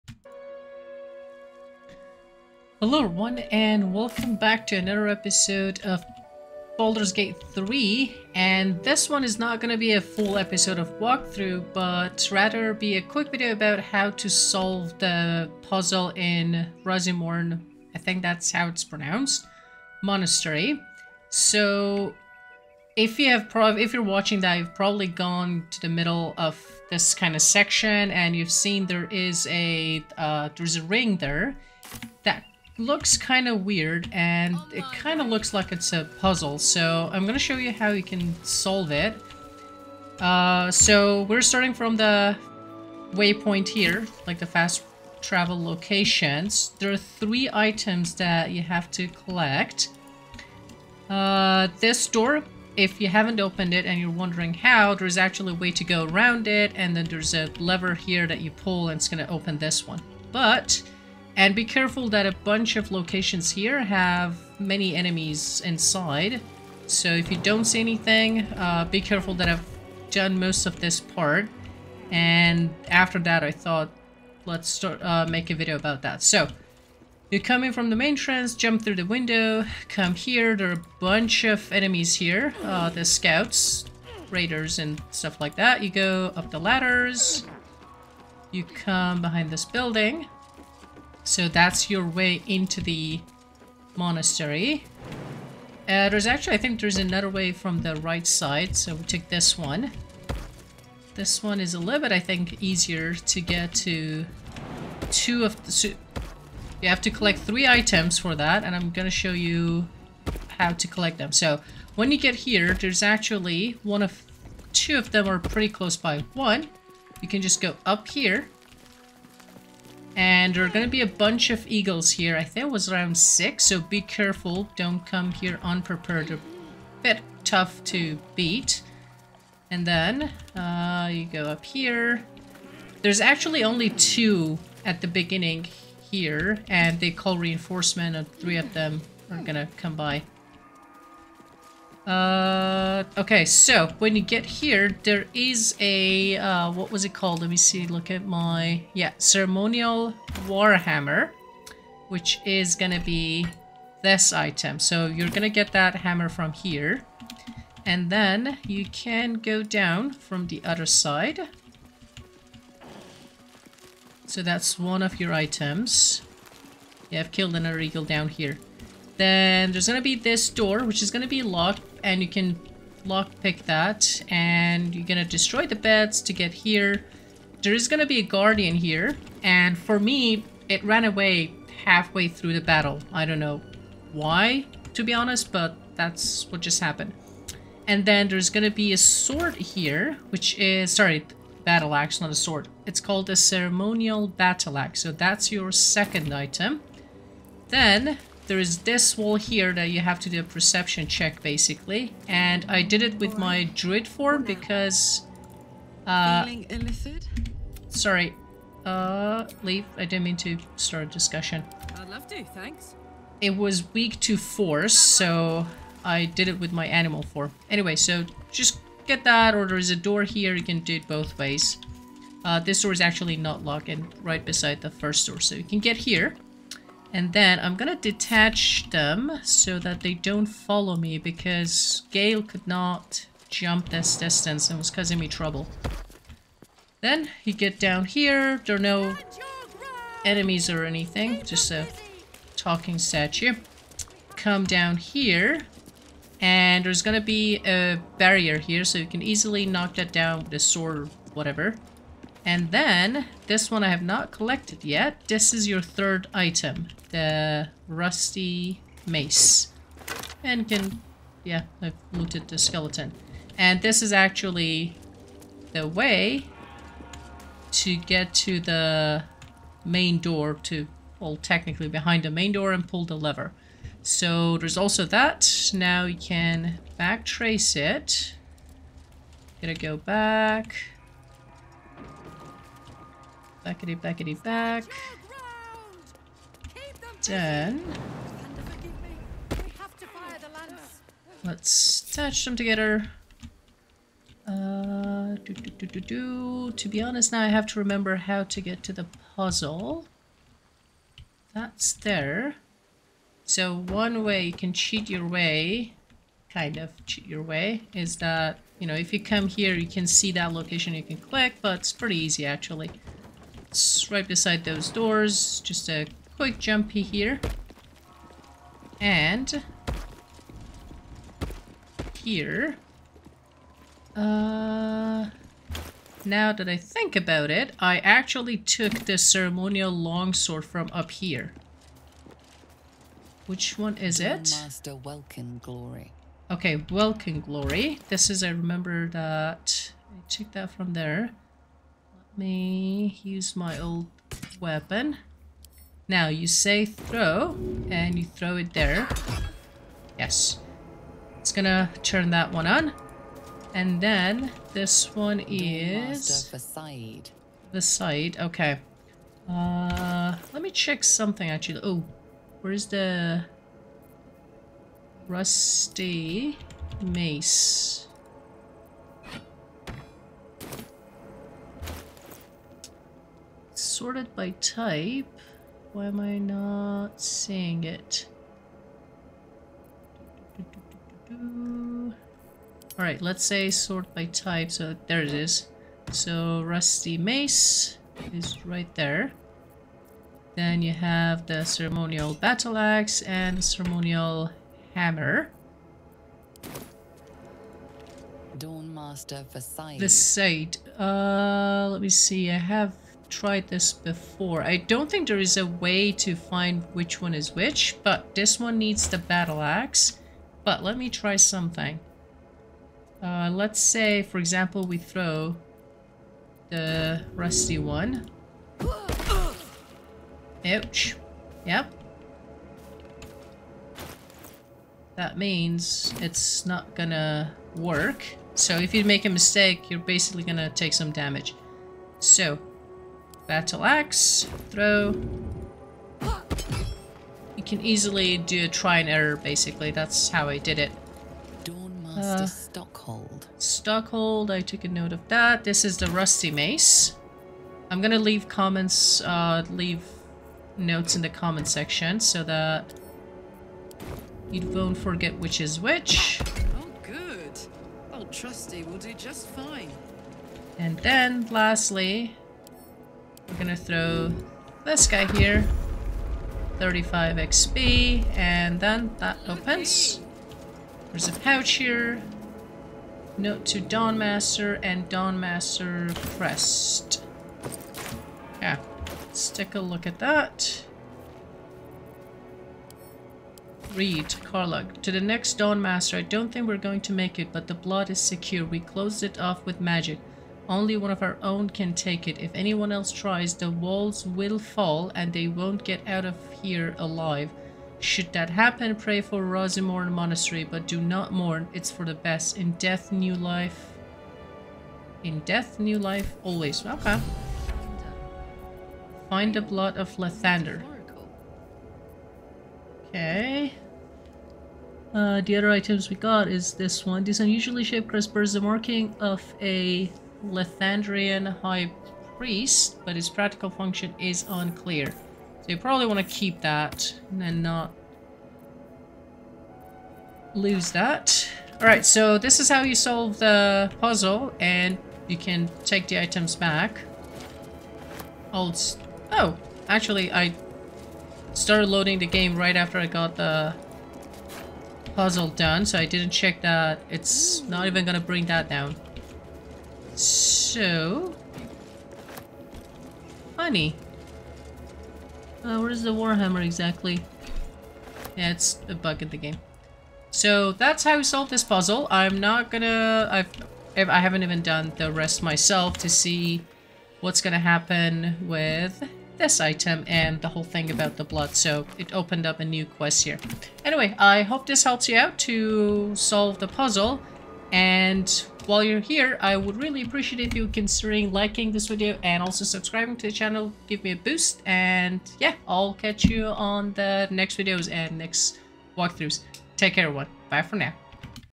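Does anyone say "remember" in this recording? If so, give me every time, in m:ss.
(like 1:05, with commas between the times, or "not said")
4:57, 5:38.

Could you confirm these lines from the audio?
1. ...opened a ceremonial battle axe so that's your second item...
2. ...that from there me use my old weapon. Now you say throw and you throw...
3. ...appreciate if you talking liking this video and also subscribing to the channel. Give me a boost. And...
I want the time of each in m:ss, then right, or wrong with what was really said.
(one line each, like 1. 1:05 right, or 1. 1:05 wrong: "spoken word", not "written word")
1. 3:13 wrong: "called", not "opened"
2. 5:40 right
3. 9:40 wrong: "considering", not "talking".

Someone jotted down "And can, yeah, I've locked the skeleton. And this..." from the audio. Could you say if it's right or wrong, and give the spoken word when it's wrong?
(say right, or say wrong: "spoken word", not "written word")
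wrong: "looted", not "locked".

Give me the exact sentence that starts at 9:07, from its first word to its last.
It's not even gonna bring that down.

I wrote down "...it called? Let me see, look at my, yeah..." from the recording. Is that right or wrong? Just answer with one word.
right.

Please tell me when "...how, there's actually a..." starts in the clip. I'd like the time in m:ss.
0:54.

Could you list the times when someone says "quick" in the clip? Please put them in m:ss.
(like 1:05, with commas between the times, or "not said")
0:13, 5:16.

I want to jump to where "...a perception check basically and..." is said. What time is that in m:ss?
3:20.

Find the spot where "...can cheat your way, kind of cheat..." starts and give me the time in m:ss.
5:04.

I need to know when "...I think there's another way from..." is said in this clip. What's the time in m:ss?
1:36.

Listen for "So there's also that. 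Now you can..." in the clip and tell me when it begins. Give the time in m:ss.
4:34.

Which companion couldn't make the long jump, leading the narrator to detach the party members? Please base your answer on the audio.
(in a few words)
Gale.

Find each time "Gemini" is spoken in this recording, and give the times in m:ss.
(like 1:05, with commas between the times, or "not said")
not said.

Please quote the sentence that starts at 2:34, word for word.
So you're gonna get that hammer from here.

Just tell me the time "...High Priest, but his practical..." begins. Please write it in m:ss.
8:41.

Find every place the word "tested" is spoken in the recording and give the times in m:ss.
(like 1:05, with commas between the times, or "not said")
not said.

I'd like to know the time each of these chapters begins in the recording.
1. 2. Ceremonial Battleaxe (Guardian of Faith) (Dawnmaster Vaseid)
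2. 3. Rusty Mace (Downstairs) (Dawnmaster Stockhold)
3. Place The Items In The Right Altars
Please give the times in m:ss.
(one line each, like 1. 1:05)
1. 2:40
2. 3:20
3. 4:30.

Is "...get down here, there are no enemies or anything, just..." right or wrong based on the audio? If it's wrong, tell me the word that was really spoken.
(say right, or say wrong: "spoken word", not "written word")
right.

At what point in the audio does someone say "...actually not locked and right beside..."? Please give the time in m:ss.
3:42.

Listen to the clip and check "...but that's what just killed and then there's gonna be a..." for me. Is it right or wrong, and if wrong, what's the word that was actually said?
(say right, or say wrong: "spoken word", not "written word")
wrong: "happened", not "killed".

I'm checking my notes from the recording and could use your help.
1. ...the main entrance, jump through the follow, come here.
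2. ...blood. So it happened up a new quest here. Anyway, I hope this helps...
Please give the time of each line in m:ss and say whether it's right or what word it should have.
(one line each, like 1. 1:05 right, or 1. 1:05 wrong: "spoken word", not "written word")
1. 1:17 wrong: "window", not "follow"
2. 9:31 wrong: "opened", not "happened".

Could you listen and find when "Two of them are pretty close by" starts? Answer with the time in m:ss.
1:54.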